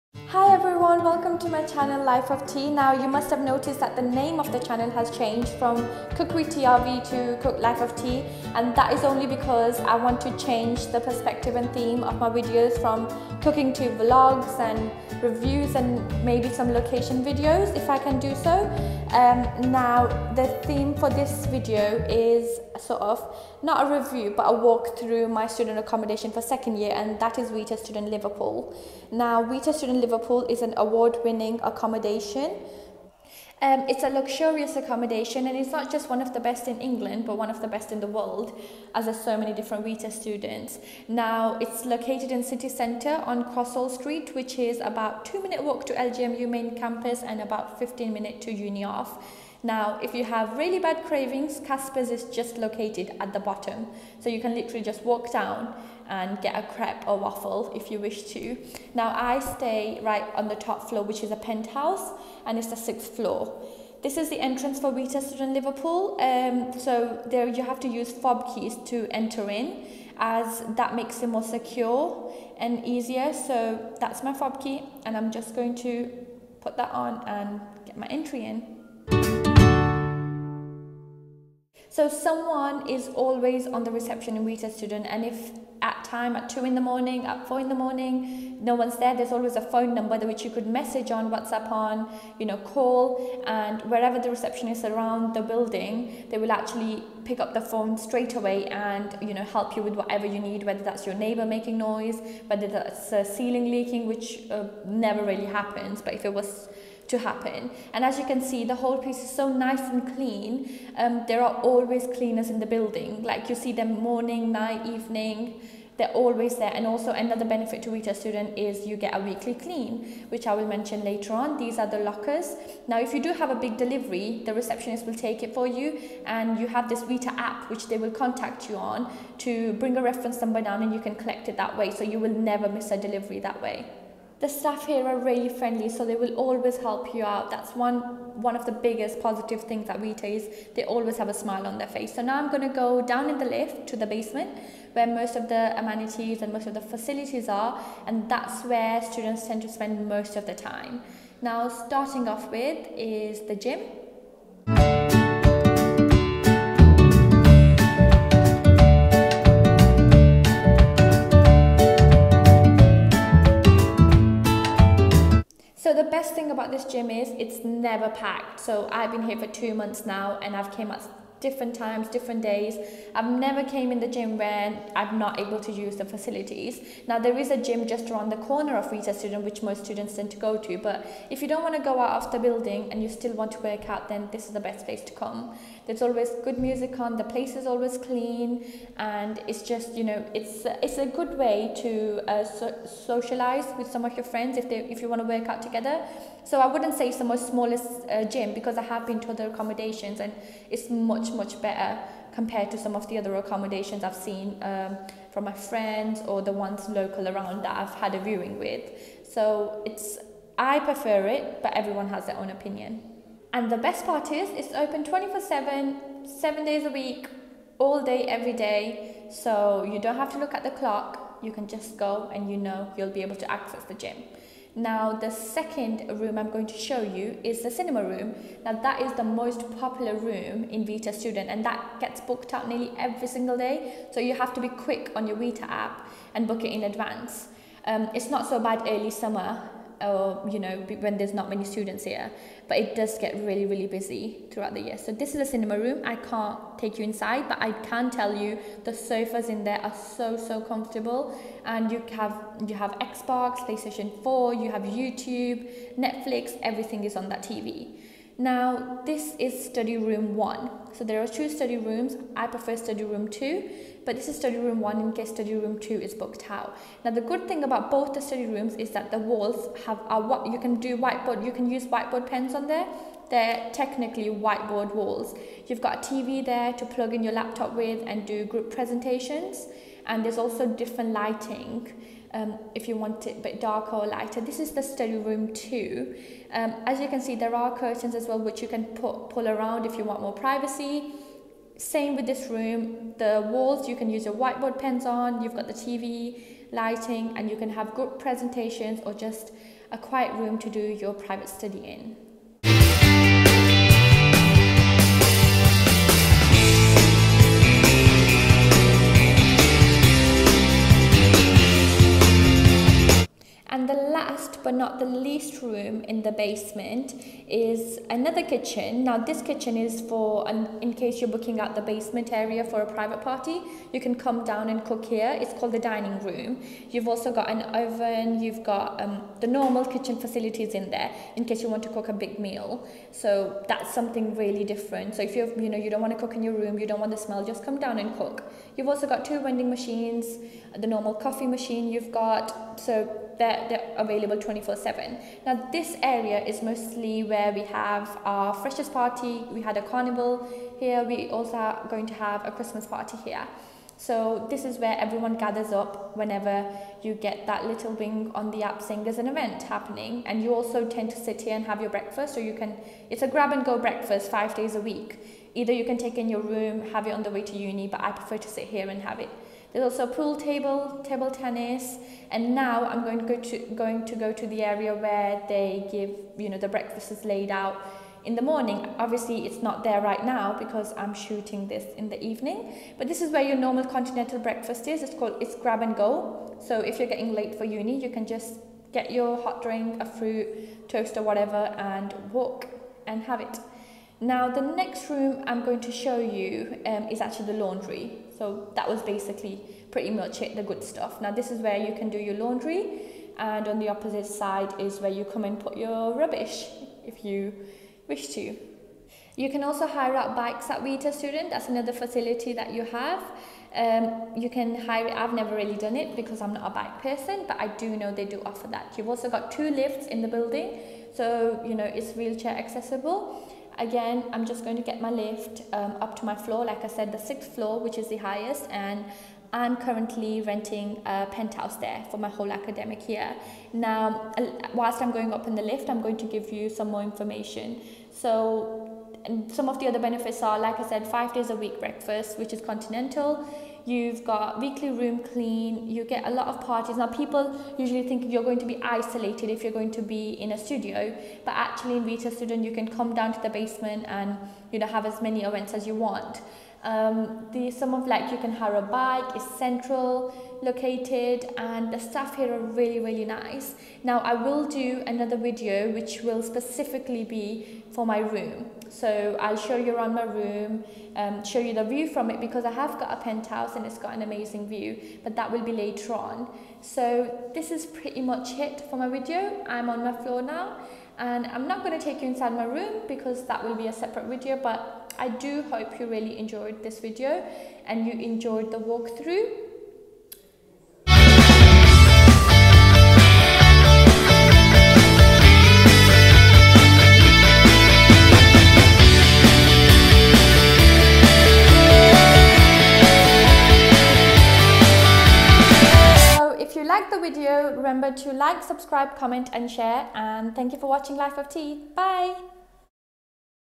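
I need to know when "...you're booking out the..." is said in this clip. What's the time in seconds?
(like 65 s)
321 s.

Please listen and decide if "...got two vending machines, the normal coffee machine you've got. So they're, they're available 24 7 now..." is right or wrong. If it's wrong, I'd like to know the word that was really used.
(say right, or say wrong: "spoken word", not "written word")
right.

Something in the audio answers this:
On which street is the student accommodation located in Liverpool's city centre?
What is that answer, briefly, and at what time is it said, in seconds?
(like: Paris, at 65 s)
Crosshall Street, at 43 s.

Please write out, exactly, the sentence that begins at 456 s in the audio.
Um, the some of like you can hire a bike is central located and the staff here are really really nice.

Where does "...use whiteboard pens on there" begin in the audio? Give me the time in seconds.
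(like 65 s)
271 s.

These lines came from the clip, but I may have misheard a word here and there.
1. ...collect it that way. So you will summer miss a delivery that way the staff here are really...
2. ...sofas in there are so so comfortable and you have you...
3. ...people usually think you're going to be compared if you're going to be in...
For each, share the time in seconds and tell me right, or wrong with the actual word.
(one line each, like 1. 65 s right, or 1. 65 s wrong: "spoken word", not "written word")
1. 131 s wrong: "never", not "summer"
2. 248 s right
3. 447 s wrong: "isolated", not "compared".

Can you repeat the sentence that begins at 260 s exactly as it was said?
So there are two study rooms.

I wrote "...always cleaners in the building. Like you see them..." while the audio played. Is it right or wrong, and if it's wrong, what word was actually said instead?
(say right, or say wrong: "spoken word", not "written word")
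right.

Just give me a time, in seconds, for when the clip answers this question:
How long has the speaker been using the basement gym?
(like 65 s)
169 s.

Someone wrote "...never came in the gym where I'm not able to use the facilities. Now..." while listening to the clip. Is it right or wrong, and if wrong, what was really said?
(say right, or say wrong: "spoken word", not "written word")
right.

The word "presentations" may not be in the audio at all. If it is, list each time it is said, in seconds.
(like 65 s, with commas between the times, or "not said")
278 s, 298 s.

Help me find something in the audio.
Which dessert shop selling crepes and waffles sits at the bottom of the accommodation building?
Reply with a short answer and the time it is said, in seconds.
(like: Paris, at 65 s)
Kaspa's, at 51 s.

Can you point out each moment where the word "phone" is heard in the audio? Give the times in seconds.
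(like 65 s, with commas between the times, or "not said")
89 s, 97 s.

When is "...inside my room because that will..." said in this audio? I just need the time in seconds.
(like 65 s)
482 s.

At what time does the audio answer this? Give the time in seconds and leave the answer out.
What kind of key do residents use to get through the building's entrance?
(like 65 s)
68 s.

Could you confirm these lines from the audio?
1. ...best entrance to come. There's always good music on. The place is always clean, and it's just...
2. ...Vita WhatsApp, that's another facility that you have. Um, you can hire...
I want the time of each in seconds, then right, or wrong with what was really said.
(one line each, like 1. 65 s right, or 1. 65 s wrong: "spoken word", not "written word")
1. 184 s wrong: "place", not "entrance"
2. 410 s wrong: "Student", not "WhatsApp".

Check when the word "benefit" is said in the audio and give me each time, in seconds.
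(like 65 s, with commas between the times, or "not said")
117 s, 439 s.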